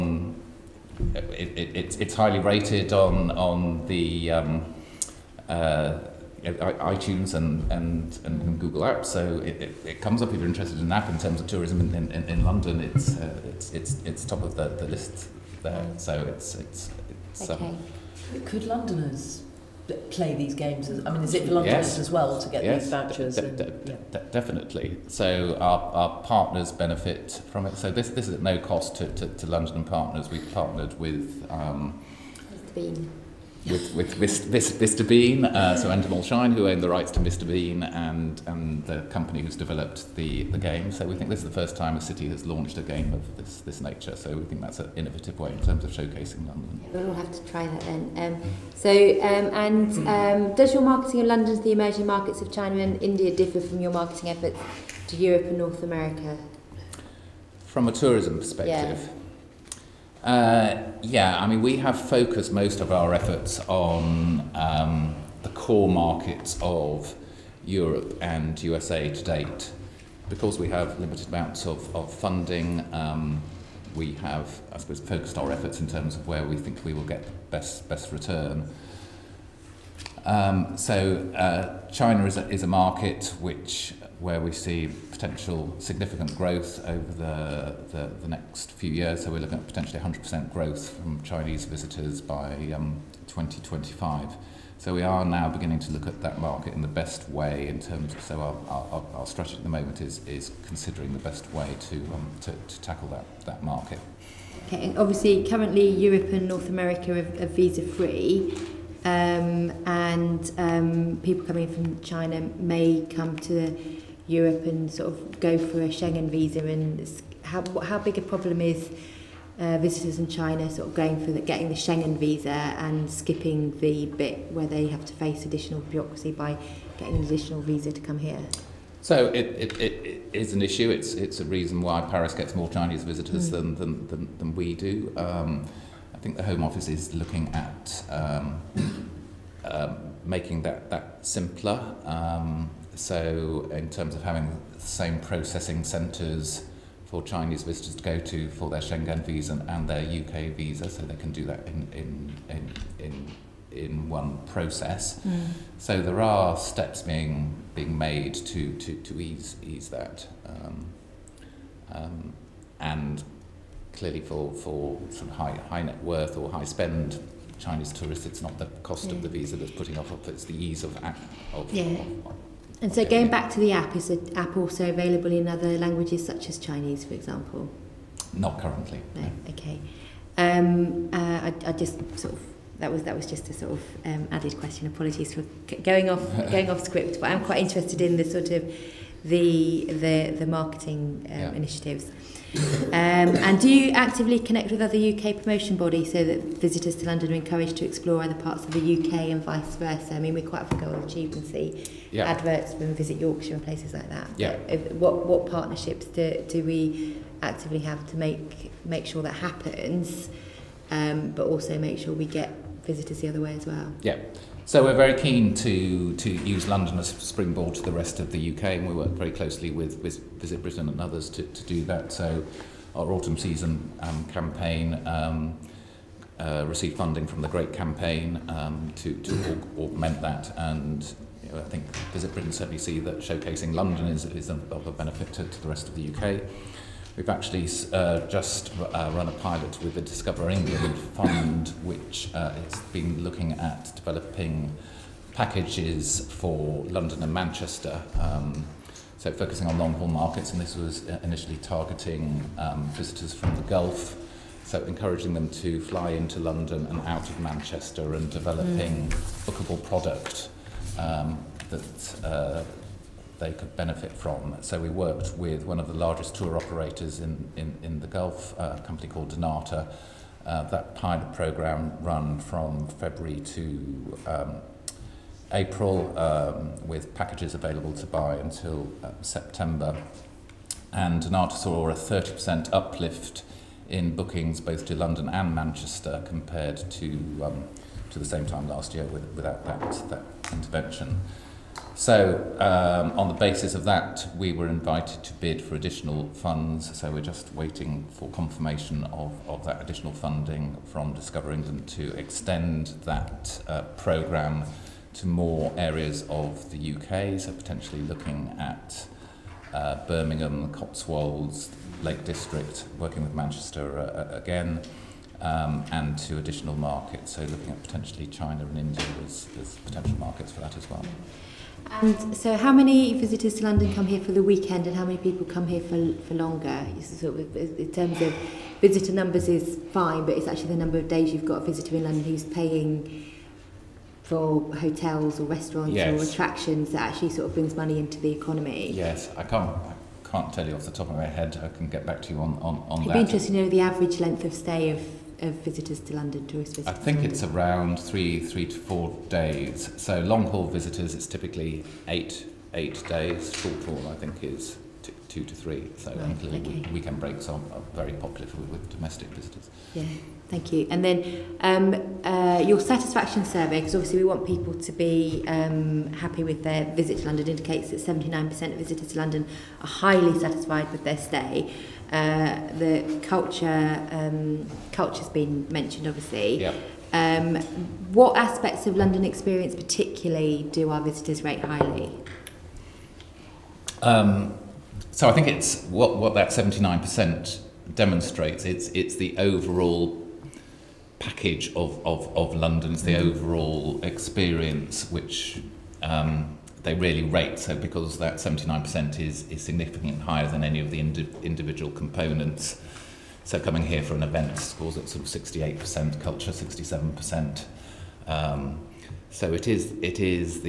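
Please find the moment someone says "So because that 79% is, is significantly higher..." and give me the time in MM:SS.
06:37.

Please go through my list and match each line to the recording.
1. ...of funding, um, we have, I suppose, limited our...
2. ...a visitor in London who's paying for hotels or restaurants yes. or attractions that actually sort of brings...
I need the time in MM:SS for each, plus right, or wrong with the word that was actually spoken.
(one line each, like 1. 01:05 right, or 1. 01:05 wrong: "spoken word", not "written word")
1. 01:11 wrong: "focused", not "limited"
2. 05:31 right.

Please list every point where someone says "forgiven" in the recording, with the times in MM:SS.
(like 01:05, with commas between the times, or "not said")
not said.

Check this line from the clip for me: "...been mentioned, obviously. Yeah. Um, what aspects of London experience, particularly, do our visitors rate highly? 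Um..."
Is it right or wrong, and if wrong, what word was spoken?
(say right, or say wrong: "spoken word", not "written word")
right.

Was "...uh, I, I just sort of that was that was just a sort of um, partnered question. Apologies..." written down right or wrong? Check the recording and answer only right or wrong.
wrong.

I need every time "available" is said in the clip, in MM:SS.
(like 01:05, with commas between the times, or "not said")
02:54, 04:37.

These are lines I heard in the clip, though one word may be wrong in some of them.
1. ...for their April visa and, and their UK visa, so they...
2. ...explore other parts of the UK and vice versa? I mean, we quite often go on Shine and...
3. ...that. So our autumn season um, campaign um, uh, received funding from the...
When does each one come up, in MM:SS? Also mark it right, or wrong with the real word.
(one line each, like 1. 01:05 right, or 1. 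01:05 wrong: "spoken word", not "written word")
1. 02:28 wrong: "Schengen", not "April"
2. 03:17 wrong: "YouTube", not "Shine"
3. 03:41 right.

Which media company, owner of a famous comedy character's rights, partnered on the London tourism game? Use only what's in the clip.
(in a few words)
Endemol Shine.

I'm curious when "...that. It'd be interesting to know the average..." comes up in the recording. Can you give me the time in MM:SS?
05:43.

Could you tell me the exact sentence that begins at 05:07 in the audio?
So, potentially looking at uh, Birmingham, the Cotswolds, Lake District, working with Manchester uh, uh, again.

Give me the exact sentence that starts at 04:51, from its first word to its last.
So, um, on the basis of that, we were invited to bid for additional funds.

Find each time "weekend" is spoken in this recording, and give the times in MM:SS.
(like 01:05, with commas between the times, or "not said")
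05:24, 05:56.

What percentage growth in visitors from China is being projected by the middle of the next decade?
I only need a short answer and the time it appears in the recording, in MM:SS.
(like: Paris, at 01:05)
100%, at 01:29.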